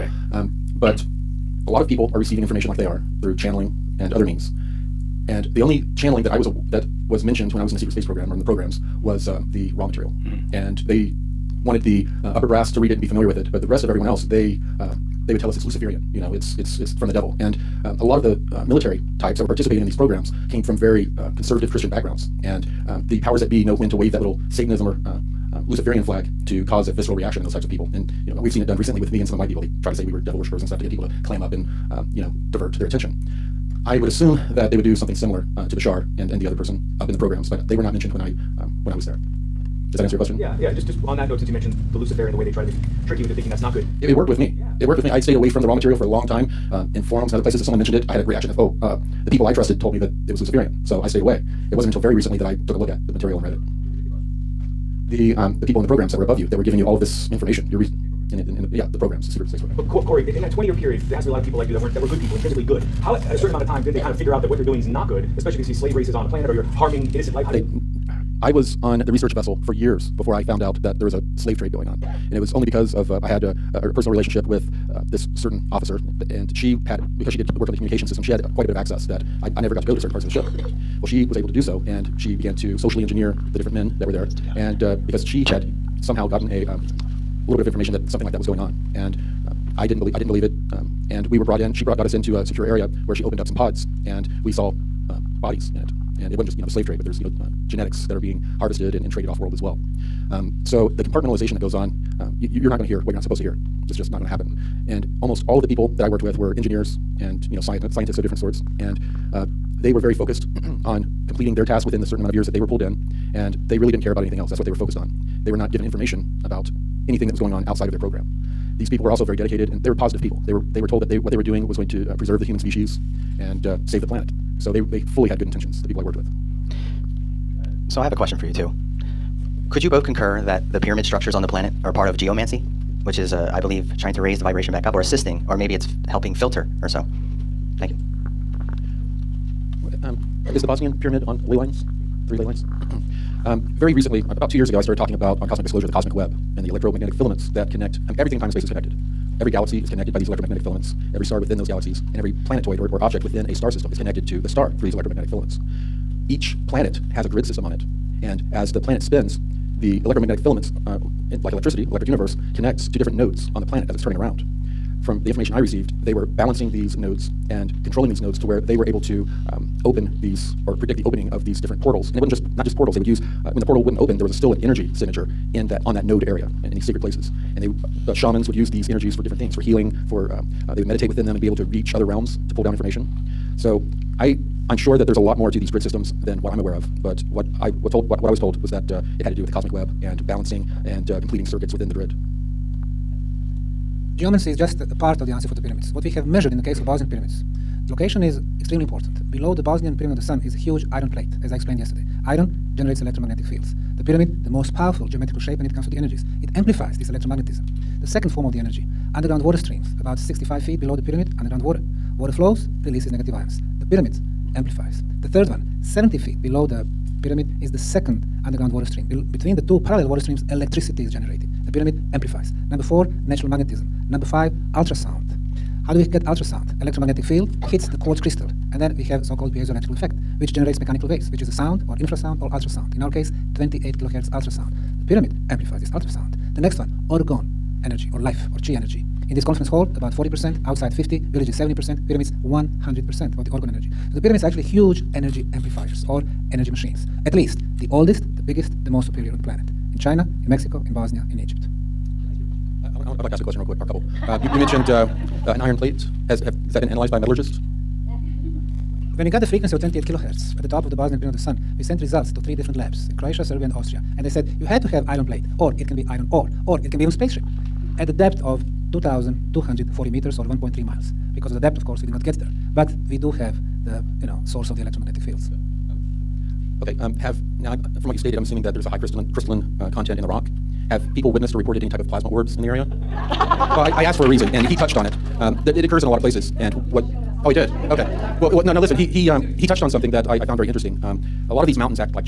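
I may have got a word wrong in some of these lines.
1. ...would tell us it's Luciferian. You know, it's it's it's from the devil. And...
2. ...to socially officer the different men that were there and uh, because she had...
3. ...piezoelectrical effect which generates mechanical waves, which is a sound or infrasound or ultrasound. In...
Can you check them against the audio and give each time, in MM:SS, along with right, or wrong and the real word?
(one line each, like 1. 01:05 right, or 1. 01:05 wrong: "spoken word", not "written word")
1. 00:15 right
2. 01:22 wrong: "engineer", not "officer"
3. 03:49 right.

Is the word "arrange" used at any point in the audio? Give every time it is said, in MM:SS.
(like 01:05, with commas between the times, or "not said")
not said.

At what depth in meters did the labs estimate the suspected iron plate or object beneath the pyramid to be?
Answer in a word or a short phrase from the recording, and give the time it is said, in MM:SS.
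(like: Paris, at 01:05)
2,240 meters, at 04:28.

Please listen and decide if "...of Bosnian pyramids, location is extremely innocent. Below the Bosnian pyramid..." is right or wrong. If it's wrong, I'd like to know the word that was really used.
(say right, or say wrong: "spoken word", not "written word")
wrong: "important", not "innocent".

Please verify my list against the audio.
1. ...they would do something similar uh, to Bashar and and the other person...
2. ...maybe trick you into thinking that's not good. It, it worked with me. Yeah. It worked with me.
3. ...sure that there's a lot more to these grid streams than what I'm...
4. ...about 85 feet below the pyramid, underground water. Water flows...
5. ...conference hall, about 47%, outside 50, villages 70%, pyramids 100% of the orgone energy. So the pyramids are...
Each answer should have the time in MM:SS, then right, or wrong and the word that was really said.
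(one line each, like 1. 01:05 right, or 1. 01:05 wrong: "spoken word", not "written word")
1. 00:34 right
2. 00:42 right
3. 03:04 wrong: "systems", not "streams"
4. 03:29 wrong: "65", not "85"
5. 03:59 wrong: "40", not "47".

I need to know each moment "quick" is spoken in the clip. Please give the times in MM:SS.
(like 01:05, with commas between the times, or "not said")
04:13.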